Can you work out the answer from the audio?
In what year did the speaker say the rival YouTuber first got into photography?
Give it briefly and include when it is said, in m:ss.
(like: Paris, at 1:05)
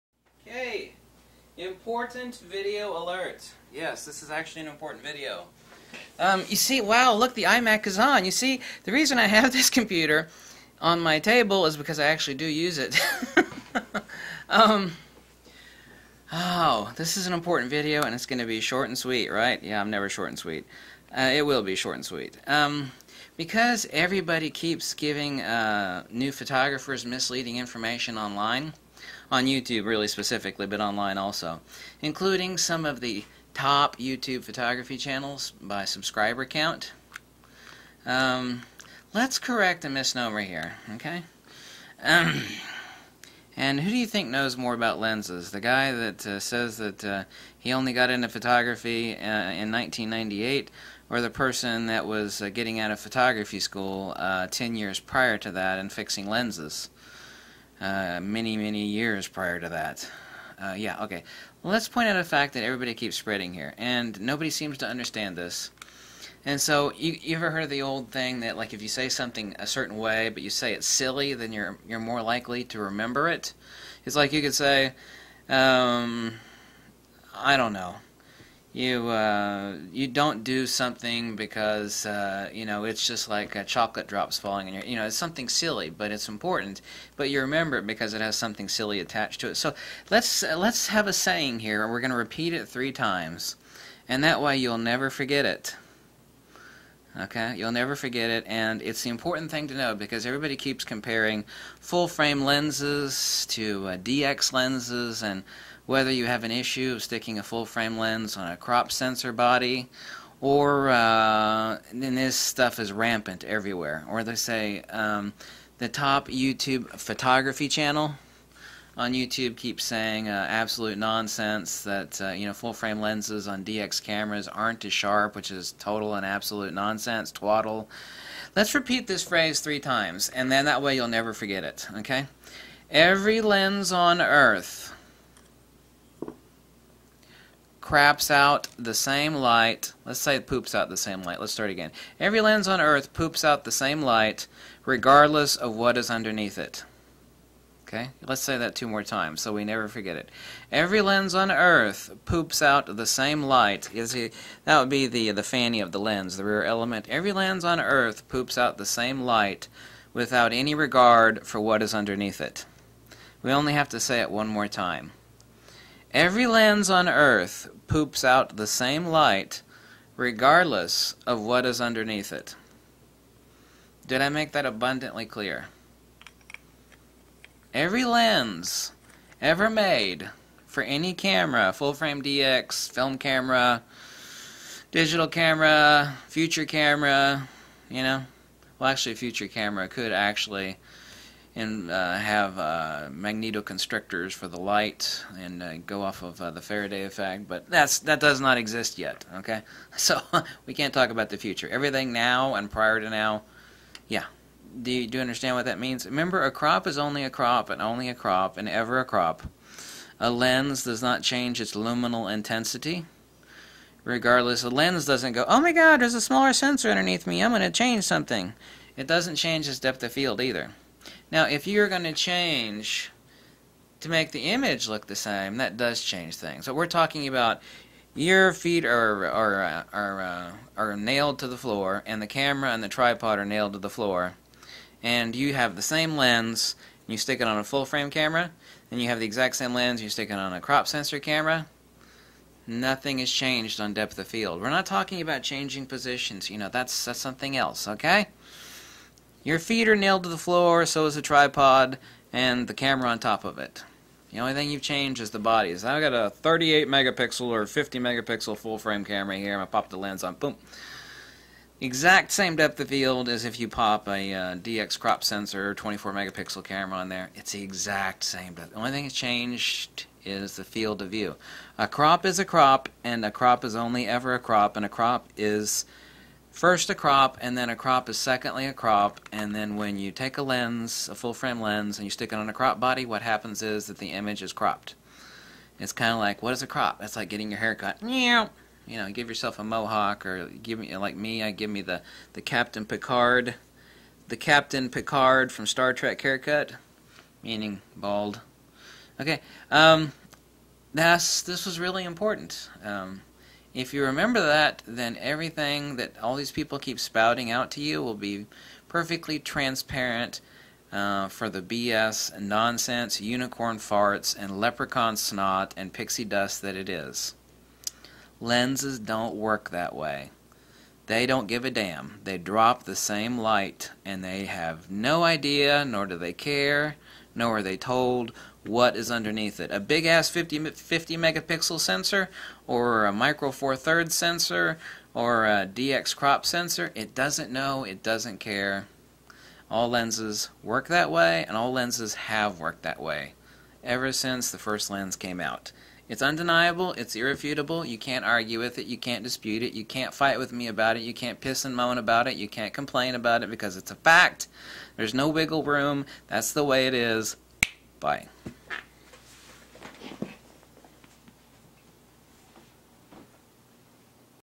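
1998, at 0:49.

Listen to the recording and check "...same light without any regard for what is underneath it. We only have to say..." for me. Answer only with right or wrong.
right.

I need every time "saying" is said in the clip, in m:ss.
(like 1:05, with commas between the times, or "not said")
1:31, 1:59.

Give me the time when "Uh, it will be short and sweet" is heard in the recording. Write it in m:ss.
0:21.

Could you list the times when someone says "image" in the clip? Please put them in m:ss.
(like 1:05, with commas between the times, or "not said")
3:44, 4:44.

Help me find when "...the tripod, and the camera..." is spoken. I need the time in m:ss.
4:11.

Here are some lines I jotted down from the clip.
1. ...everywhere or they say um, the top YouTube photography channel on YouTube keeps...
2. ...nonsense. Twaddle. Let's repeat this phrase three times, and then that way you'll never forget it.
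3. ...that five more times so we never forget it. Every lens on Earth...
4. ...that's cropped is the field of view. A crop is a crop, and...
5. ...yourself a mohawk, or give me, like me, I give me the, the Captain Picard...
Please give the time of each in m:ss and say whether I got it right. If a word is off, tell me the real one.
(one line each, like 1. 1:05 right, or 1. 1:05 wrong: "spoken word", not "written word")
1. 1:53 right
2. 2:06 right
3. 2:28 wrong: "two", not "five"
4. 4:29 wrong: "changed", not "cropped"
5. 4:49 right.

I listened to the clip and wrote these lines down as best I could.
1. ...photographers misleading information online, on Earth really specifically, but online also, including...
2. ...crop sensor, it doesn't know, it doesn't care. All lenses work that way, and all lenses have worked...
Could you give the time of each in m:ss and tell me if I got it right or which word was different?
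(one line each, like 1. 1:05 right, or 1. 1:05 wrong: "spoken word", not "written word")
1. 0:26 wrong: "YouTube", not "Earth"
2. 5:36 right.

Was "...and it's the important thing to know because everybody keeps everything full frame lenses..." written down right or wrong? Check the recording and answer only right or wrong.
wrong.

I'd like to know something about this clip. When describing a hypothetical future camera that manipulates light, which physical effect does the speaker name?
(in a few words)
Faraday effect.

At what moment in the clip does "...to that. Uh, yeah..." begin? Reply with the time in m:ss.
0:59.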